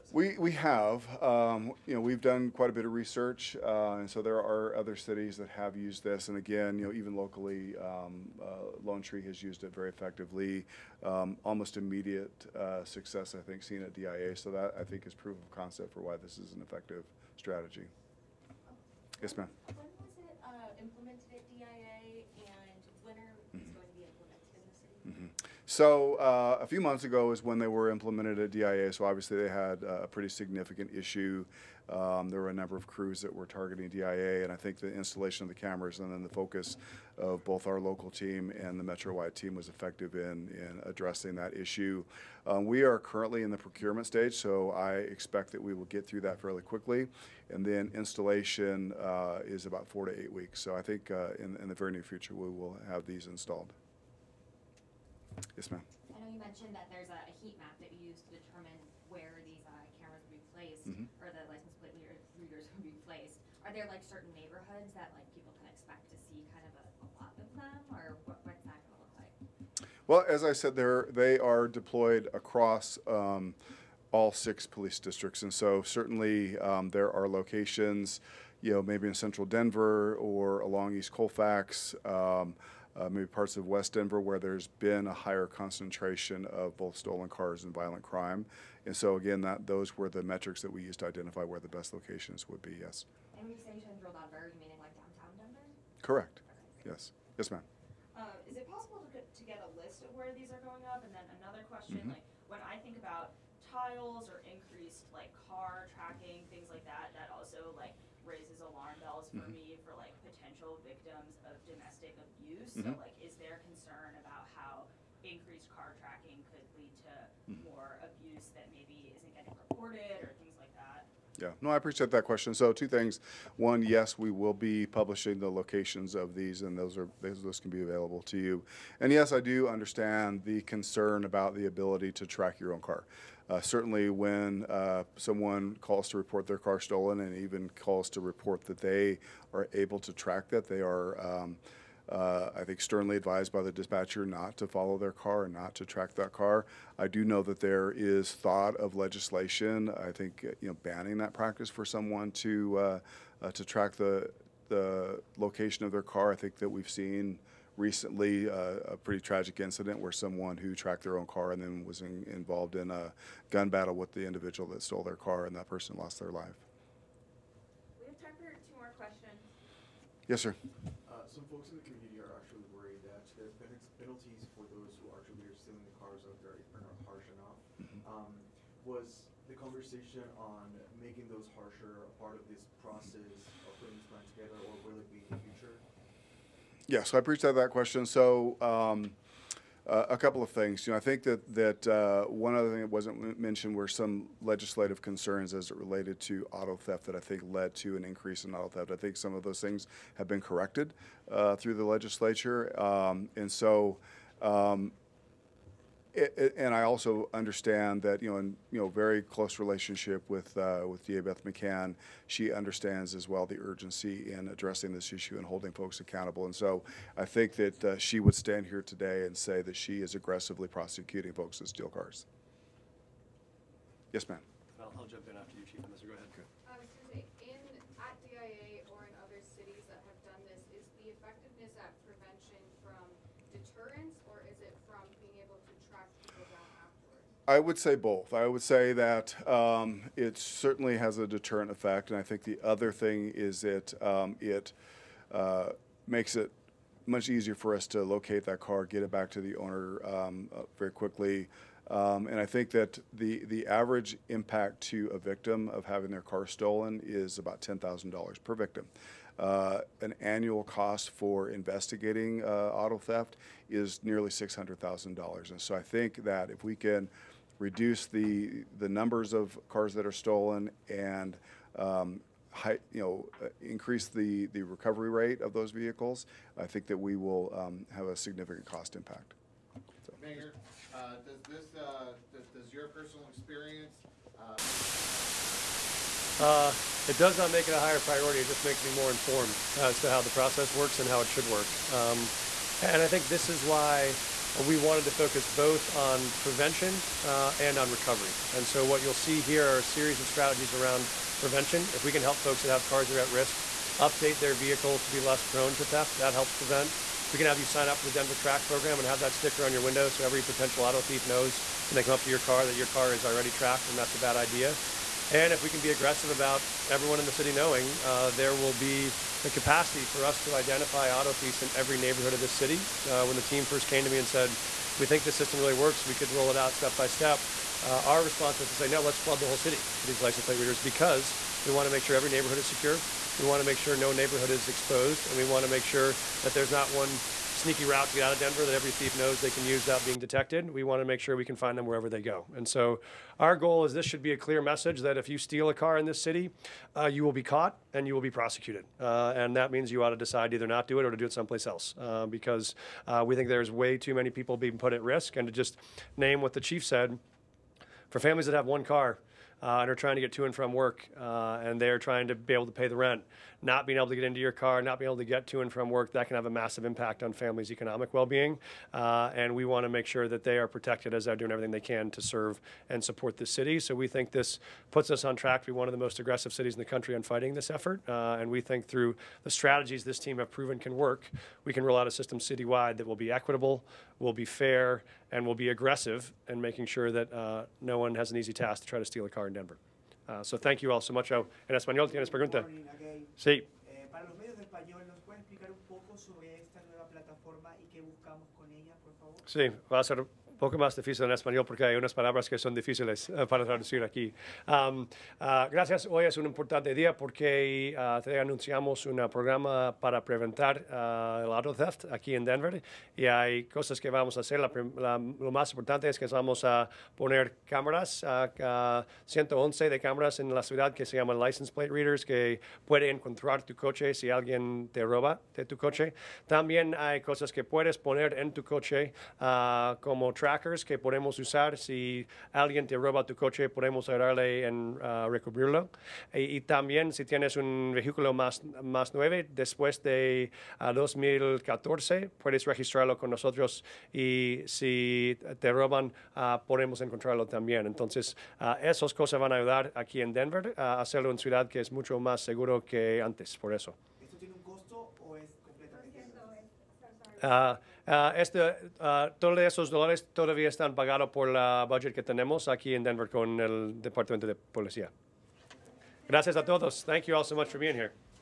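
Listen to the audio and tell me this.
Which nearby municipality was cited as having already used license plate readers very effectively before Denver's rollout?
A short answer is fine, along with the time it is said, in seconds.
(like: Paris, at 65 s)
Lone Tree, at 8 s.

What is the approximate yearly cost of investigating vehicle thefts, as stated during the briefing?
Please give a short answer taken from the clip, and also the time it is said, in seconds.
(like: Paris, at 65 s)
nearly $600,000, at 264 s.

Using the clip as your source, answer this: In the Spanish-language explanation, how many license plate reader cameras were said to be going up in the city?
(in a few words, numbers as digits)
111.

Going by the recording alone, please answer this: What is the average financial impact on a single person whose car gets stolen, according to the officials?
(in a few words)
$10,000.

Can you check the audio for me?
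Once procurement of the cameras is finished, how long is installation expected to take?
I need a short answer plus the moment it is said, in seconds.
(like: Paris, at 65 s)
4 to 8 weeks, at 49 s.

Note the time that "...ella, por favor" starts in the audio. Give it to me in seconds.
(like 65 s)
398 s.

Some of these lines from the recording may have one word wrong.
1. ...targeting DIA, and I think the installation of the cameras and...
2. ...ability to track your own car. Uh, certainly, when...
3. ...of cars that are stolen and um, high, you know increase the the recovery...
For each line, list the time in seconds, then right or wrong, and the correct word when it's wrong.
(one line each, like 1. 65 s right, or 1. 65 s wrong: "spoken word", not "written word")
1. 33 s right
2. 131 s right
3. 269 s right.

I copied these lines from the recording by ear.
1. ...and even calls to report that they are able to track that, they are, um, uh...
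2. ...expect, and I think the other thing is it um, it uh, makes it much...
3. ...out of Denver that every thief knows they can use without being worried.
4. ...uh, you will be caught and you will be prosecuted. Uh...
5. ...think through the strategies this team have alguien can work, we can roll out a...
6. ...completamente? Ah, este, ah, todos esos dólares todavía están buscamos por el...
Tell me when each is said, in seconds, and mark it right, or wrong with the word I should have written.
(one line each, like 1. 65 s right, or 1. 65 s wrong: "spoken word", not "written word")
1. 137 s right
2. 241 s wrong: "effect", not "expect"
3. 338 s wrong: "detected", not "worried"
4. 346 s right
5. 378 s wrong: "proven", not "alguien"
6. 455 s wrong: "pagados", not "buscamos".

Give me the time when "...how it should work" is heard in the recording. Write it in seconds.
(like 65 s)
291 s.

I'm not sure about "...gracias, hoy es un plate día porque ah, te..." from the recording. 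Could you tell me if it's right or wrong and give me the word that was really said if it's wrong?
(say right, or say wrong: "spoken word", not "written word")
wrong: "importante", not "plate".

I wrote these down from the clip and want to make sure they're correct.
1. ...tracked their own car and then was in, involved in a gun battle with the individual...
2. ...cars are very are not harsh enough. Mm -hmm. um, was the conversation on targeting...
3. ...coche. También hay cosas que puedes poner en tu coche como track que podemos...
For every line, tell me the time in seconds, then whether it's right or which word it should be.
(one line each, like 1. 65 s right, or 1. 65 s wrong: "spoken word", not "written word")
1. 160 s right
2. 176 s wrong: "making", not "targeting"
3. 425 s right.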